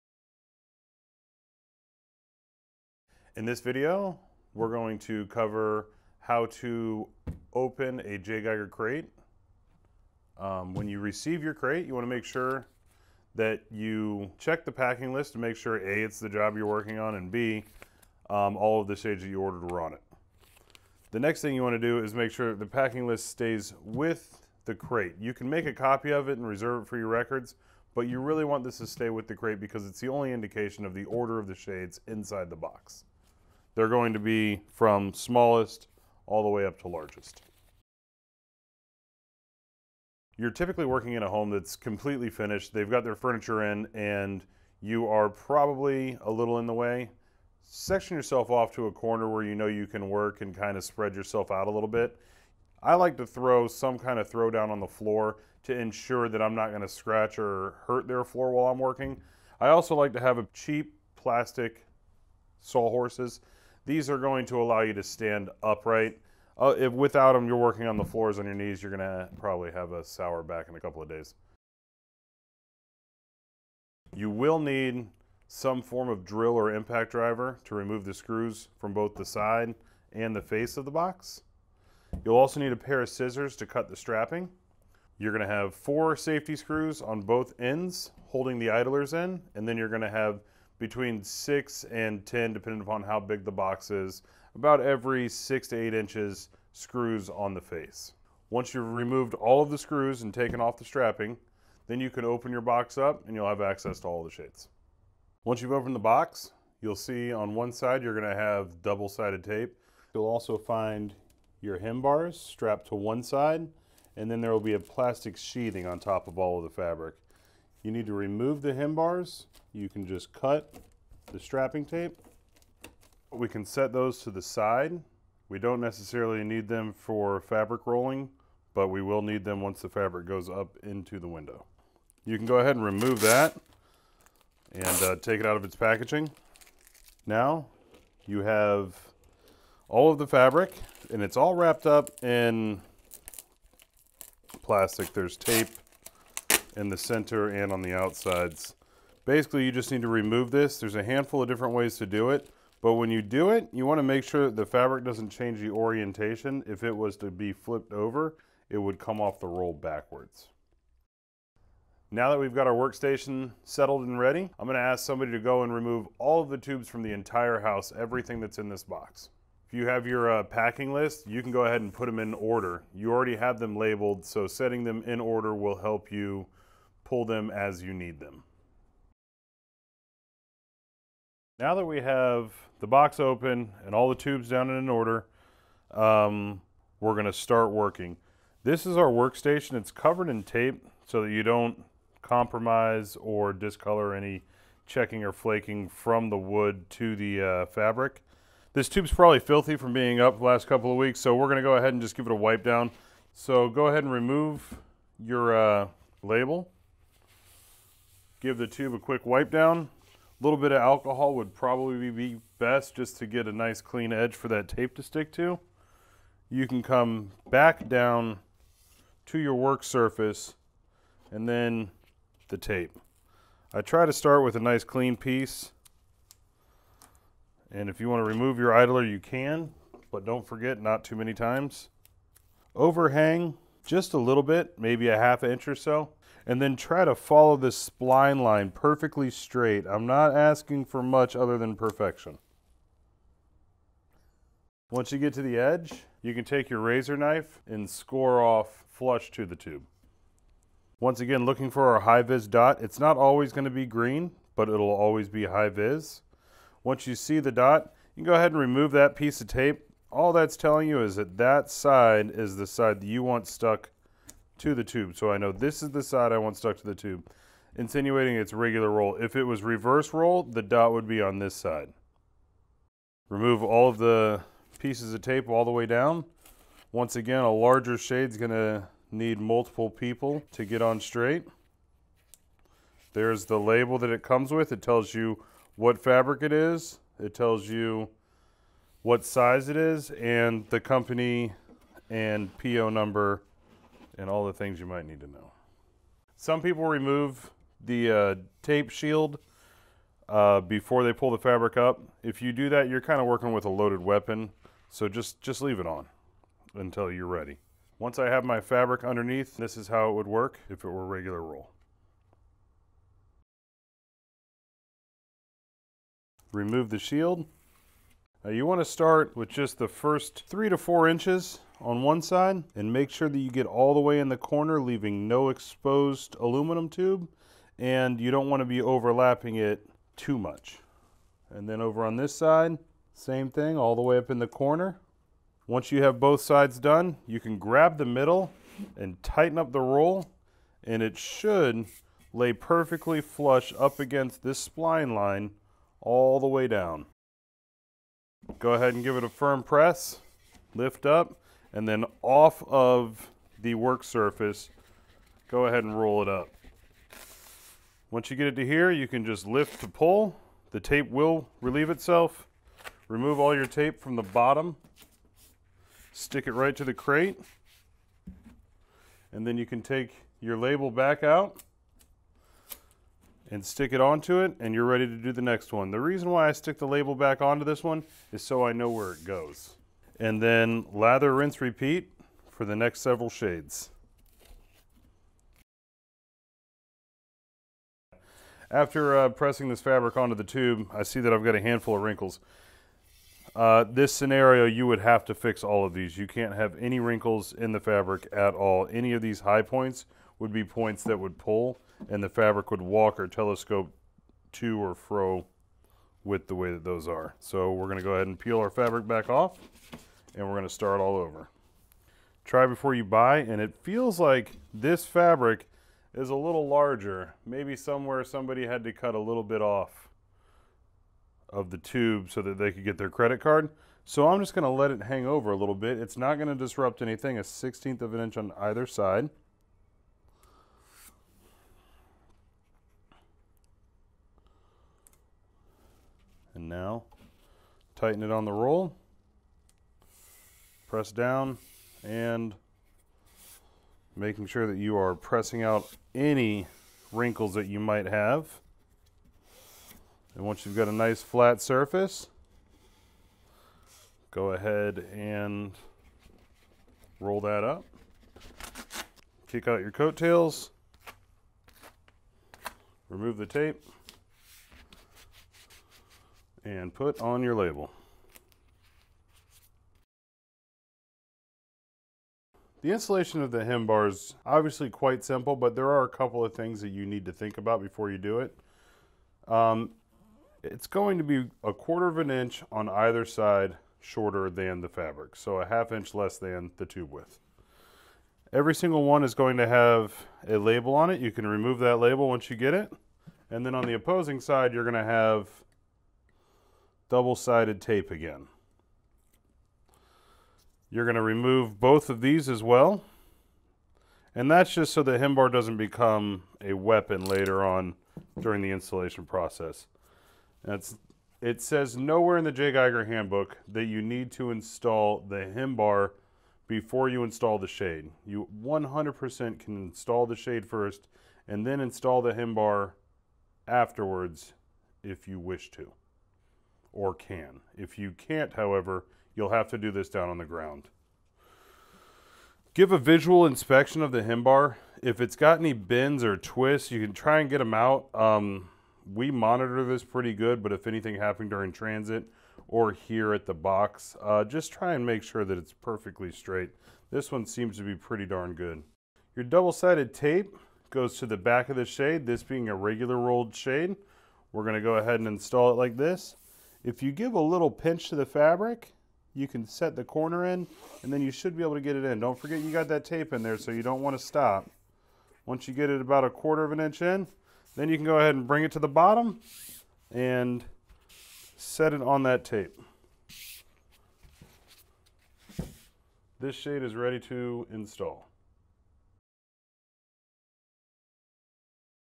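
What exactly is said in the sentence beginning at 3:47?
And if you want to remove your idler, you can, but don't forget, not too many times.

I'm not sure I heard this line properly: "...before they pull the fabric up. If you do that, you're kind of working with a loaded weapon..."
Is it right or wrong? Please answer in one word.
right.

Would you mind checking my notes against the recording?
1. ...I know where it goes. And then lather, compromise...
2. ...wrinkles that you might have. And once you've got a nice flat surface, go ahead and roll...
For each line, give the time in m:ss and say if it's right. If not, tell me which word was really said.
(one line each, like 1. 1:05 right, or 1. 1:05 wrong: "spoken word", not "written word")
1. 6:18 wrong: "rinse", not "compromise"
2. 7:27 right.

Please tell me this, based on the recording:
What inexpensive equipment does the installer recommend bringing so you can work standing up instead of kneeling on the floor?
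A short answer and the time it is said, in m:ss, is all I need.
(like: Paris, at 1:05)
Plastic saw horses, at 1:01.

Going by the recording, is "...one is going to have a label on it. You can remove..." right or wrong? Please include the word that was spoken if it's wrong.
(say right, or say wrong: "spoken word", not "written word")
right.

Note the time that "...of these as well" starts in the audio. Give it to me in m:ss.
8:22.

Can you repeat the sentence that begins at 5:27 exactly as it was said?
And you don't wanna be overlapping it too much.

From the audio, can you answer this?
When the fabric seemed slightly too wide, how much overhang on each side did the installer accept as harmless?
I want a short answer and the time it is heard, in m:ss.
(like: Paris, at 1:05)
1/16 inch, at 7:07.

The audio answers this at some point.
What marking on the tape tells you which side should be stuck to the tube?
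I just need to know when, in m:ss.
4:12.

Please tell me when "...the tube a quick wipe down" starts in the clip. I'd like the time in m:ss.
3:28.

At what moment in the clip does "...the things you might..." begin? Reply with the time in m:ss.
4:54.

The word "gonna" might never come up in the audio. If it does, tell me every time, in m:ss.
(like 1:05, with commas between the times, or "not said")
1:08, 1:25, 1:29, 2:44, 3:07, 3:21, 4:38, 9:14.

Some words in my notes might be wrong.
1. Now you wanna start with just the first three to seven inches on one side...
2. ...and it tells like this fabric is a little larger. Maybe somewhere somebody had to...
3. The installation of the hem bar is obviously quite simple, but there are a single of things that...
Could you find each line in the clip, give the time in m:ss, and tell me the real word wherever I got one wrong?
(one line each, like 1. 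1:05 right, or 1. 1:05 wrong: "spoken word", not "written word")
1. 5:18 wrong: "four", not "seven"
2. 6:53 wrong: "feels", not "tells"
3. 7:52 wrong: "couple", not "single".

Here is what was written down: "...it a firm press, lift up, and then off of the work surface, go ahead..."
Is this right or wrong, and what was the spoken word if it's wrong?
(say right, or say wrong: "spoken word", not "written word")
right.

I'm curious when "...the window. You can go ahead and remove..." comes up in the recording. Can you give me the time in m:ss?
2:11.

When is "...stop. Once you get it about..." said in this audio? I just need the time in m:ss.
9:24.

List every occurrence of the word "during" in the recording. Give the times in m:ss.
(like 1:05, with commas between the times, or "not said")
8:28, 9:01.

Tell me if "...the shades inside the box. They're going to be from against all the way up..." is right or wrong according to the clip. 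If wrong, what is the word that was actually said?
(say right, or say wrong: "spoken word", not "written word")
wrong: "smallest", not "against".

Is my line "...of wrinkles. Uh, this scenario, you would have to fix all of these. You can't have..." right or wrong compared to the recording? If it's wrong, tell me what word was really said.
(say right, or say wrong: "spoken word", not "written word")
right.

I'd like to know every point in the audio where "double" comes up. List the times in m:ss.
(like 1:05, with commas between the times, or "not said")
1:48, 8:17, 9:09.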